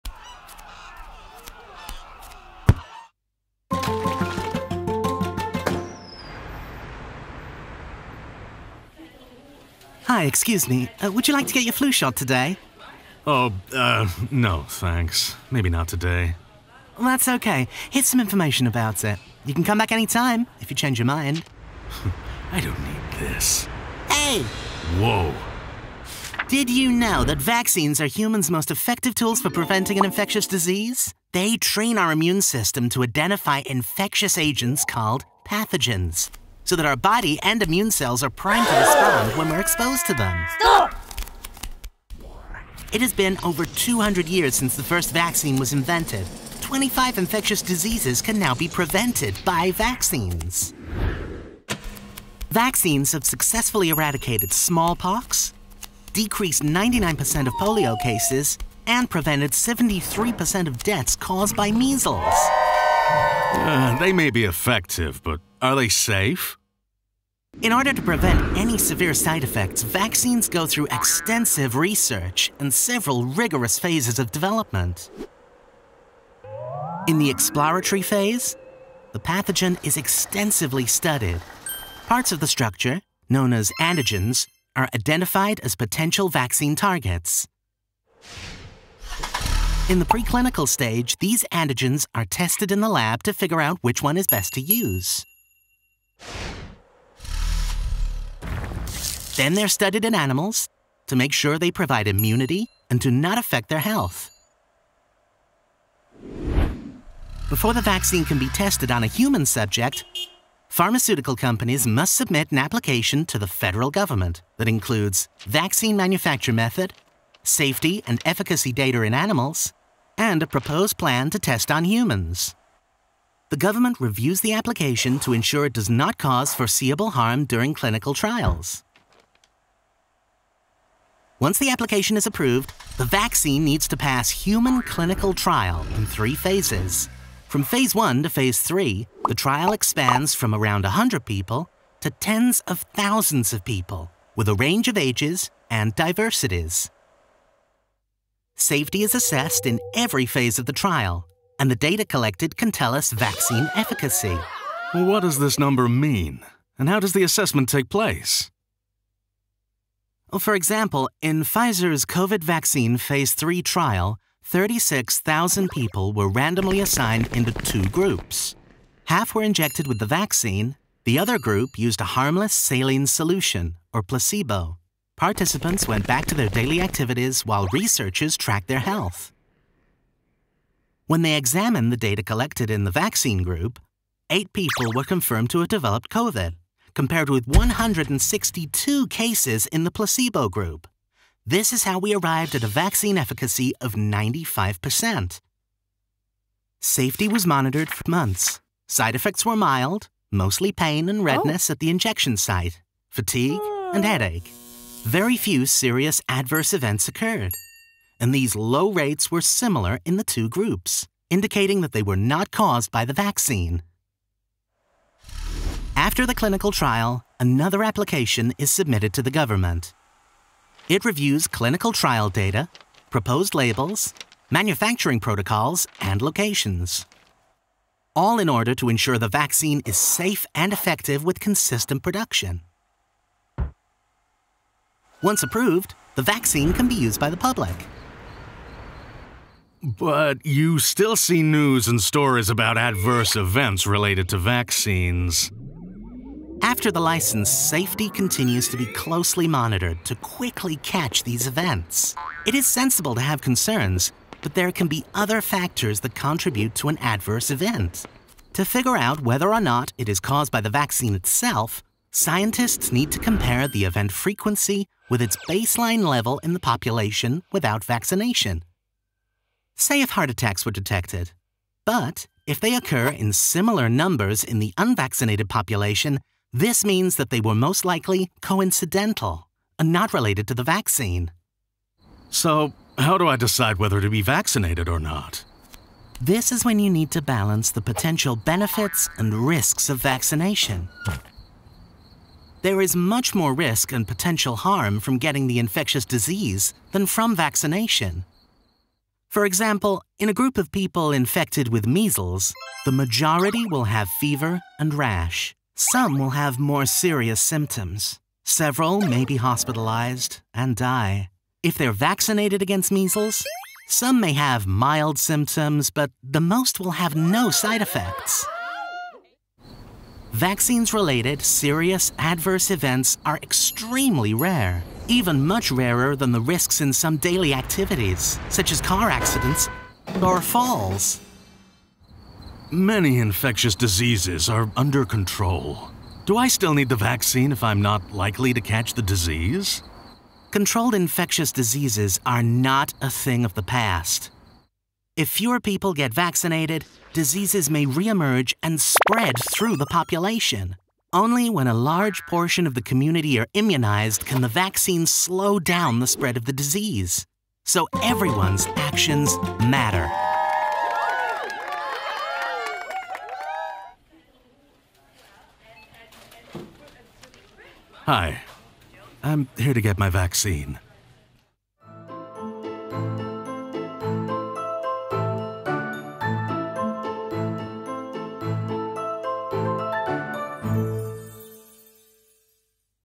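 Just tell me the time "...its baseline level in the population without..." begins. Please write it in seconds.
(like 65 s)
265 s.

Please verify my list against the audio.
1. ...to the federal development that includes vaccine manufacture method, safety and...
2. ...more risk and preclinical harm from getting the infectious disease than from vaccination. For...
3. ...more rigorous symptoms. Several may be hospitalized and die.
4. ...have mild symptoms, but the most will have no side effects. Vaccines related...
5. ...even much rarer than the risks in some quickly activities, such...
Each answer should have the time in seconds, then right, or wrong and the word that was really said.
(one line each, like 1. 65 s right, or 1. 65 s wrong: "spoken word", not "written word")
1. 113 s wrong: "government", not "development"
2. 293 s wrong: "potential", not "preclinical"
3. 306 s wrong: "serious", not "rigorous"
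4. 314 s right
5. 325 s wrong: "daily", not "quickly".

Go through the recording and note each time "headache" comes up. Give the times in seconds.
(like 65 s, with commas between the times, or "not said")
204 s.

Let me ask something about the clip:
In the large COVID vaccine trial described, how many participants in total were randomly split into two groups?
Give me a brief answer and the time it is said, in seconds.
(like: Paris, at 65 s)
36,000, at 164 s.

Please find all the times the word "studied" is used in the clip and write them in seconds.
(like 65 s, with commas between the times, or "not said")
80 s, 99 s.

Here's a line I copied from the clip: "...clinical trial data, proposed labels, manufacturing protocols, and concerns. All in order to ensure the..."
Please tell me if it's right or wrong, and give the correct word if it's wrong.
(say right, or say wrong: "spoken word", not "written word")
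wrong: "locations", not "concerns".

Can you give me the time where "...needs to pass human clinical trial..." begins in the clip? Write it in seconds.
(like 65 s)
133 s.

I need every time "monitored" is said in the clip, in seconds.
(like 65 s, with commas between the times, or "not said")
197 s, 249 s.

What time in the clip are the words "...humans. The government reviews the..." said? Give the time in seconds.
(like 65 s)
121 s.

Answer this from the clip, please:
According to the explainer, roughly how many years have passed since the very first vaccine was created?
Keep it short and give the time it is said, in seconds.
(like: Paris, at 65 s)
200, at 43 s.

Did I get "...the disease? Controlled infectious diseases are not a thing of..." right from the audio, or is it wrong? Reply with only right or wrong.
right.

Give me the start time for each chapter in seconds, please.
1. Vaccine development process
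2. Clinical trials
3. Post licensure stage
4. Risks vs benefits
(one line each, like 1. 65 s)
1. 63 s
2. 130 s
3. 237 s
4. 280 s.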